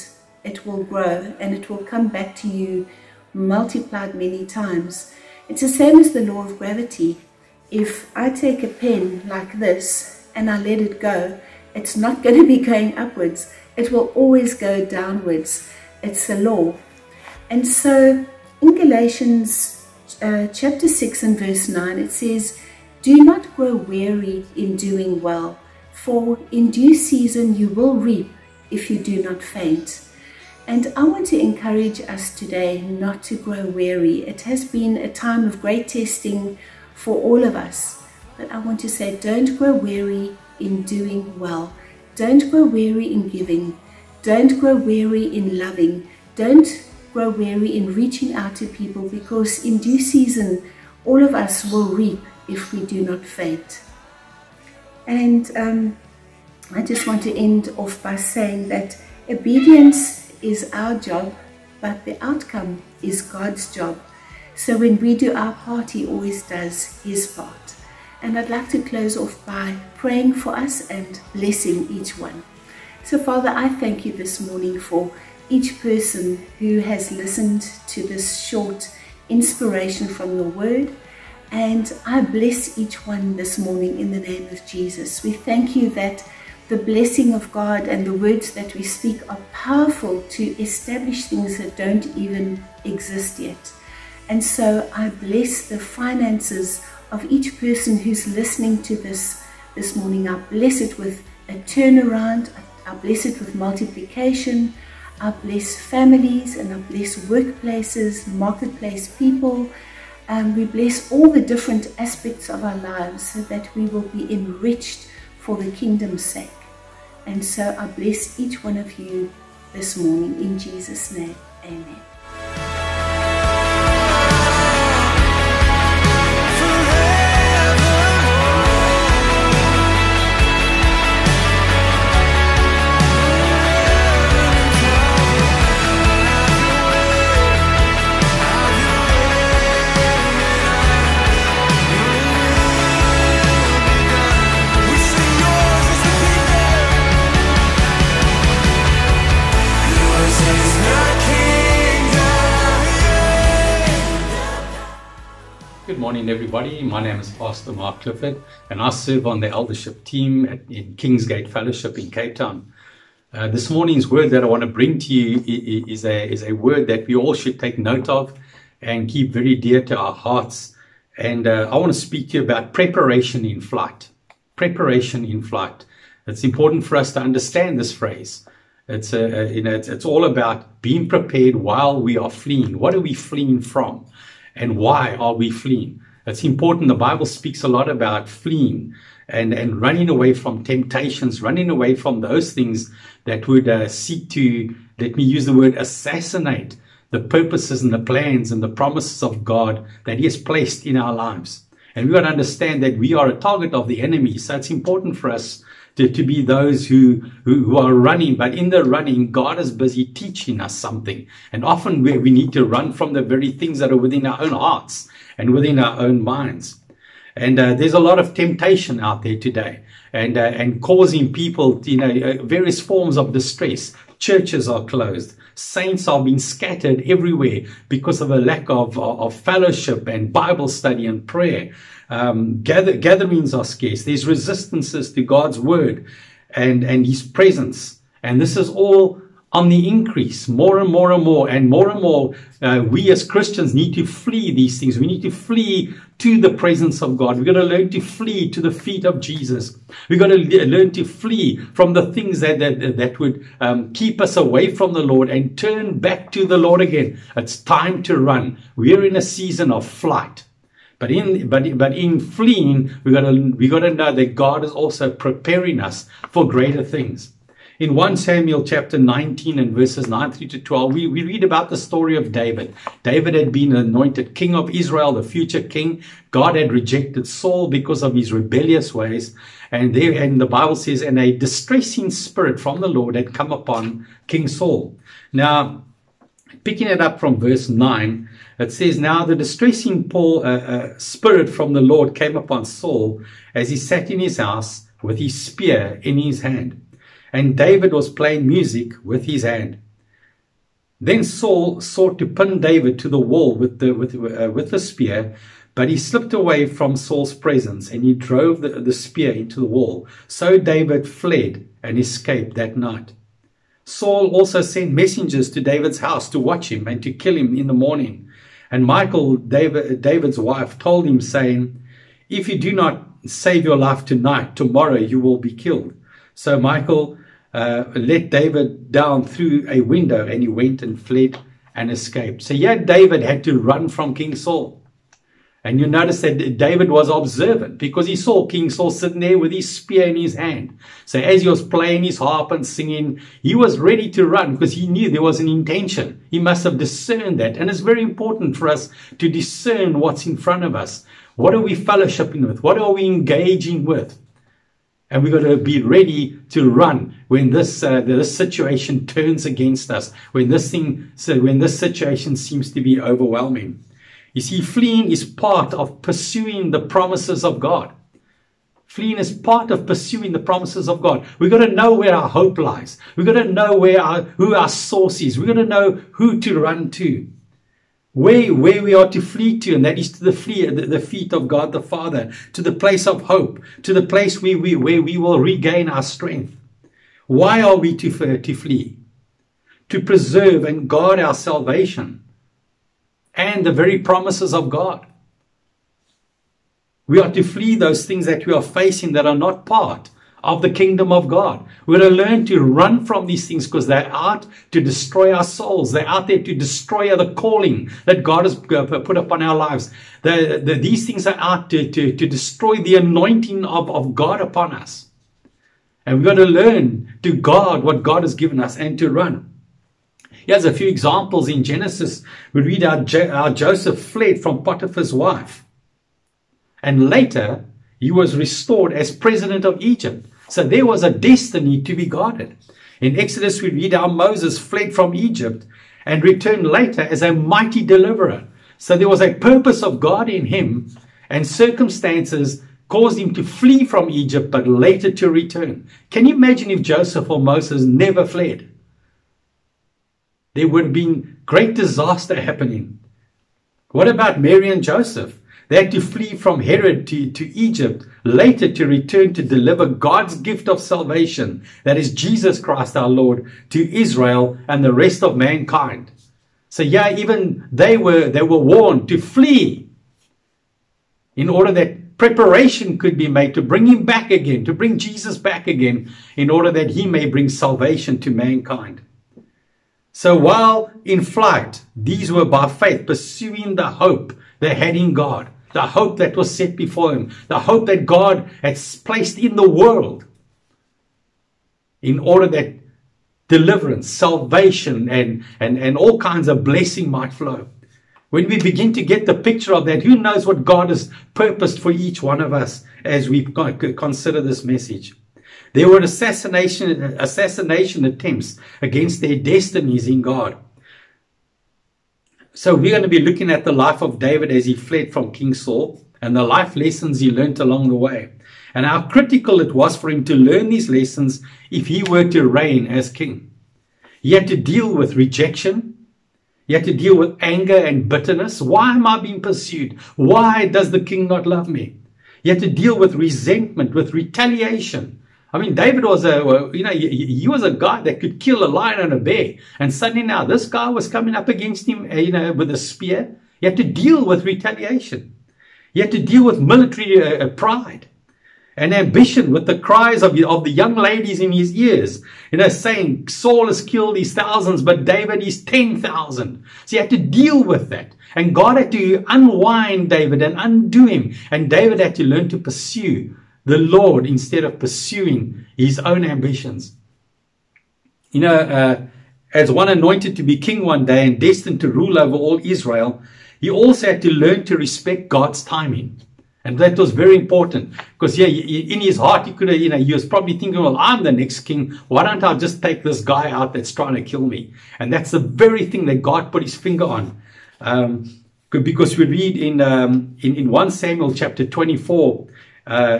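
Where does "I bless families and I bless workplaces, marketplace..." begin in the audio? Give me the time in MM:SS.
01:45.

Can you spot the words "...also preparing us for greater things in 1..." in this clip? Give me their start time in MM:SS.
04:24.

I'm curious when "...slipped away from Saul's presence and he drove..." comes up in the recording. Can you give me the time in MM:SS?
05:05.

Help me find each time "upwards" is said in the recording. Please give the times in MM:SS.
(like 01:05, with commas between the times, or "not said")
00:12.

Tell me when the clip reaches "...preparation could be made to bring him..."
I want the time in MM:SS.
07:52.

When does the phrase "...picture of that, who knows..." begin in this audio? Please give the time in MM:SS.
08:19.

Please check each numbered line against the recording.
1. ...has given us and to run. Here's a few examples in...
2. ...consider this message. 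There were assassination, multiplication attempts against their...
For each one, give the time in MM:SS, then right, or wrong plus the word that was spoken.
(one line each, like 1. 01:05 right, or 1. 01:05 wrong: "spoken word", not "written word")
1. 06:58 right
2. 08:23 wrong: "assassination", not "multiplication".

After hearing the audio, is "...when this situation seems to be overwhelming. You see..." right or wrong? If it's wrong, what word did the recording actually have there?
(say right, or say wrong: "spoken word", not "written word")
right.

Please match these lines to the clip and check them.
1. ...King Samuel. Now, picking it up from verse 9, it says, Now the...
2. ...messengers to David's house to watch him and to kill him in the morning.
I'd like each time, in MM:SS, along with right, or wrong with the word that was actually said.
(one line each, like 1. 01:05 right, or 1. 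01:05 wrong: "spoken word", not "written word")
1. 04:44 wrong: "Saul", not "Samuel"
2. 05:14 right.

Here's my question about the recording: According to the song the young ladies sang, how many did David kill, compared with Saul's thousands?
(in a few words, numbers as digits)
10,000.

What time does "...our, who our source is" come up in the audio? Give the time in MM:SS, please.
06:14.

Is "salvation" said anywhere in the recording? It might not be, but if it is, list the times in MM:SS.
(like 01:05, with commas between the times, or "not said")
06:31, 07:40, 07:57, 08:14.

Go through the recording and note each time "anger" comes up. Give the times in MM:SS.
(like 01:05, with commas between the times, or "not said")
08:47.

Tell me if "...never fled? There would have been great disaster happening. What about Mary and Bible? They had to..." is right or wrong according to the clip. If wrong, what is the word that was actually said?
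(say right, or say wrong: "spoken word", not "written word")
wrong: "Joseph", not "Bible".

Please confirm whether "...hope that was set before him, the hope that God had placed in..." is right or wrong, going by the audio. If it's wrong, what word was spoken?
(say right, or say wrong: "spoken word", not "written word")
right.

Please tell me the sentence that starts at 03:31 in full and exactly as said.
And often we, we need to run from the very things that are within our own hearts and within our own minds.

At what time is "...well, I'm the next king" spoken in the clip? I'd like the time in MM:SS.
09:40.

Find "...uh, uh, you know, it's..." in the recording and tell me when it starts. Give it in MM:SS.
02:59.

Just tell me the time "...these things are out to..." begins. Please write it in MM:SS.
06:50.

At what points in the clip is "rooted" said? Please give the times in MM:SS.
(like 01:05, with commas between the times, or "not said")
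not said.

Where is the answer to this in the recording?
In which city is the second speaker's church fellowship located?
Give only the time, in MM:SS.
02:42.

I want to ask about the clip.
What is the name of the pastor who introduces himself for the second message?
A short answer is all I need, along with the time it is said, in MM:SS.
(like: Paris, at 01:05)
Mark Clifford, at 02:37.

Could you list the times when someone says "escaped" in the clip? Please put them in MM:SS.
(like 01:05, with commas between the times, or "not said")
05:11, 05:31.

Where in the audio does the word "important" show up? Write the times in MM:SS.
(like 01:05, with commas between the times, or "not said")
02:56, 03:06, 03:24, 05:48, 09:37.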